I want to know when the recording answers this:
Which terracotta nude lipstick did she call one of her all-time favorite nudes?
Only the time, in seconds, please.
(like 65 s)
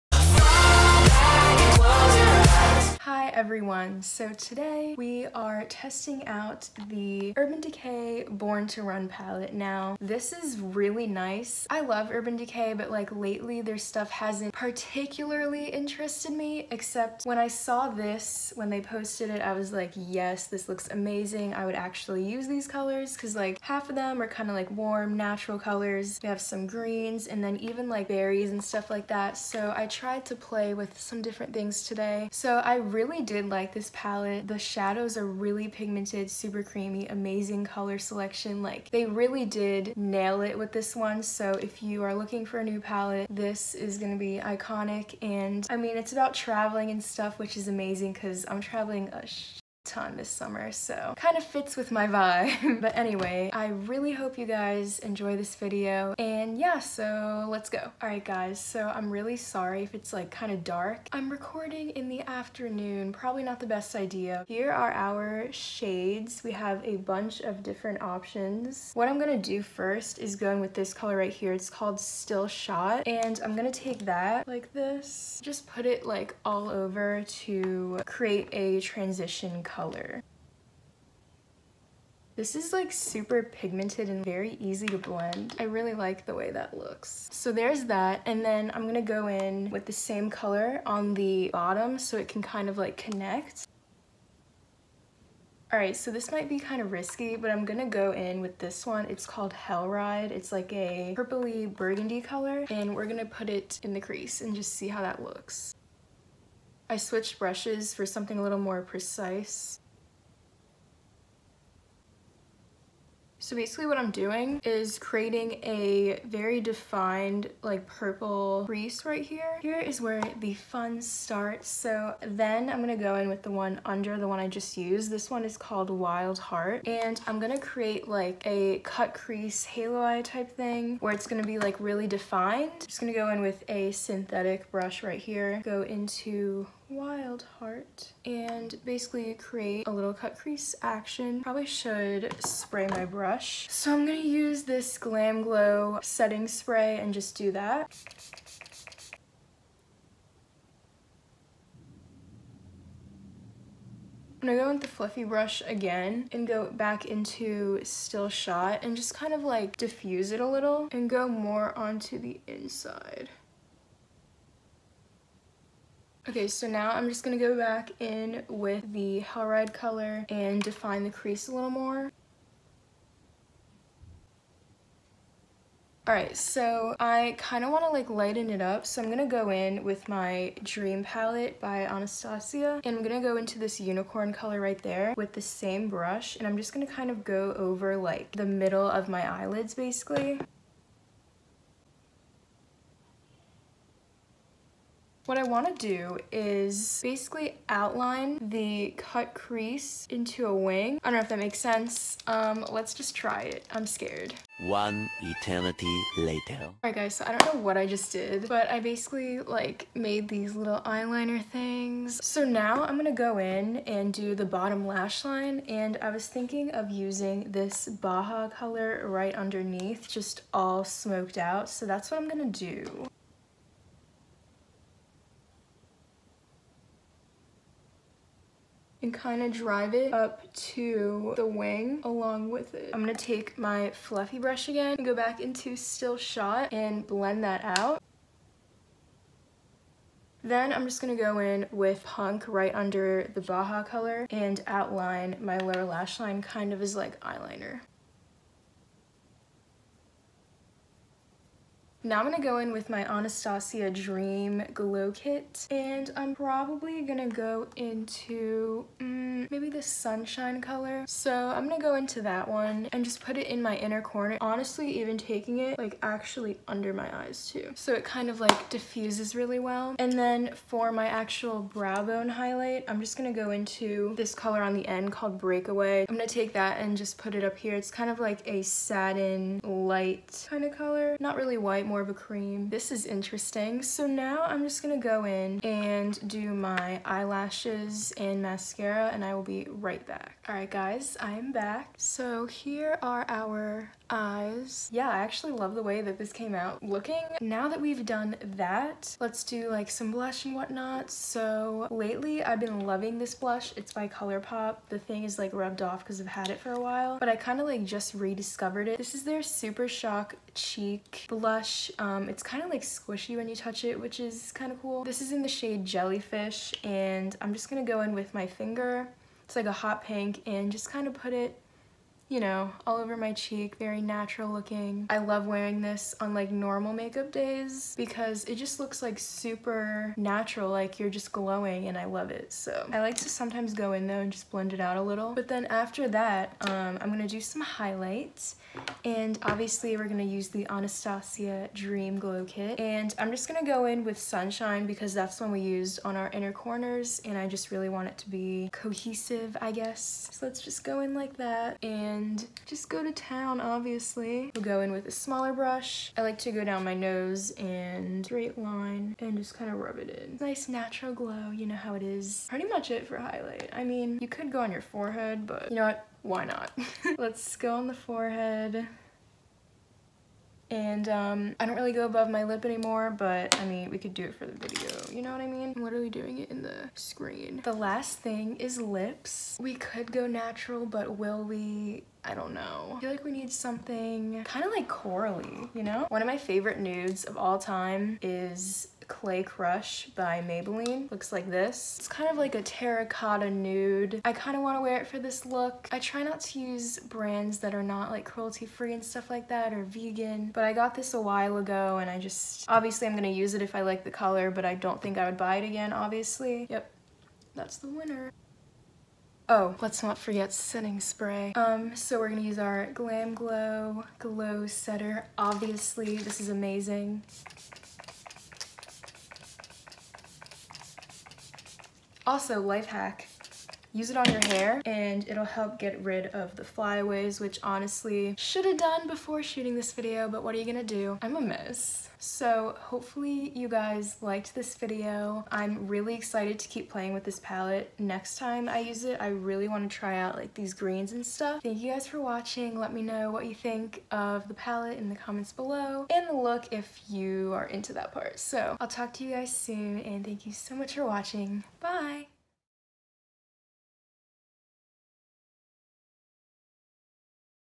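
389 s.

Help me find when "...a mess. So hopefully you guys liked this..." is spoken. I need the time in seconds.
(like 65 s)
431 s.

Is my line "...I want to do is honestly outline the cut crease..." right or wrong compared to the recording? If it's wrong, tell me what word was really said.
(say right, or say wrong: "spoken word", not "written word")
wrong: "basically", not "honestly".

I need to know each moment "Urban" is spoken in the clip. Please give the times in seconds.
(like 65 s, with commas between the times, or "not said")
7 s, 12 s.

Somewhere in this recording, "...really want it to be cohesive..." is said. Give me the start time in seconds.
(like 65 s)
347 s.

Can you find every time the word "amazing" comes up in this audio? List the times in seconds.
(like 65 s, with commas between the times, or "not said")
20 s, 37 s, 47 s, 416 s.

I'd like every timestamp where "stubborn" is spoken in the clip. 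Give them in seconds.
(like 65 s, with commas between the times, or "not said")
not said.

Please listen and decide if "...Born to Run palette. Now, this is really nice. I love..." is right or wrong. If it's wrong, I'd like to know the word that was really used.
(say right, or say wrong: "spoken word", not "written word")
right.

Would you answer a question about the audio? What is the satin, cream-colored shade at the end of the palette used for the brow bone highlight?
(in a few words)
Breakaway.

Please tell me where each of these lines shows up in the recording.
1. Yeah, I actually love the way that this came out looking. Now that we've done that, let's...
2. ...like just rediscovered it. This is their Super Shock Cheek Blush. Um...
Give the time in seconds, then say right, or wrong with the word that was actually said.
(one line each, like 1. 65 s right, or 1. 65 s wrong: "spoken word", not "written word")
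1. 294 s right
2. 307 s right.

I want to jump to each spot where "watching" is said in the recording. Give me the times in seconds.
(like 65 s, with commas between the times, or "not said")
442 s, 451 s.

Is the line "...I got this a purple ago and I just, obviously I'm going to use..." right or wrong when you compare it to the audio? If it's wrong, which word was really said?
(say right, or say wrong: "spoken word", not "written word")
wrong: "while", not "purple".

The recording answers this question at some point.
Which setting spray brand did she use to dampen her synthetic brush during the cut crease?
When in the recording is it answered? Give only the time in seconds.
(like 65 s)
144 s.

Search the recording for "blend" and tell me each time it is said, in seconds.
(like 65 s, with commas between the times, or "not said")
84 s, 237 s, 334 s.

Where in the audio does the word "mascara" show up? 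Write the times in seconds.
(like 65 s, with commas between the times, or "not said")
288 s.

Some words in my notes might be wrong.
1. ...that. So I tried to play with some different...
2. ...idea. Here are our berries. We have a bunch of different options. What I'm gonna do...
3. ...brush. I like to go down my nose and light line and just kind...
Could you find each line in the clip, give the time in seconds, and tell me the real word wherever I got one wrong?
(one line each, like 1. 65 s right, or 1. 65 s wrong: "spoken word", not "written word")
1. 29 s right
2. 63 s wrong: "shades", not "berries"
3. 355 s wrong: "straight", not "light".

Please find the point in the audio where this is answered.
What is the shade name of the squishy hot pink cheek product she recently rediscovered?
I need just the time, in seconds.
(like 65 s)
315 s.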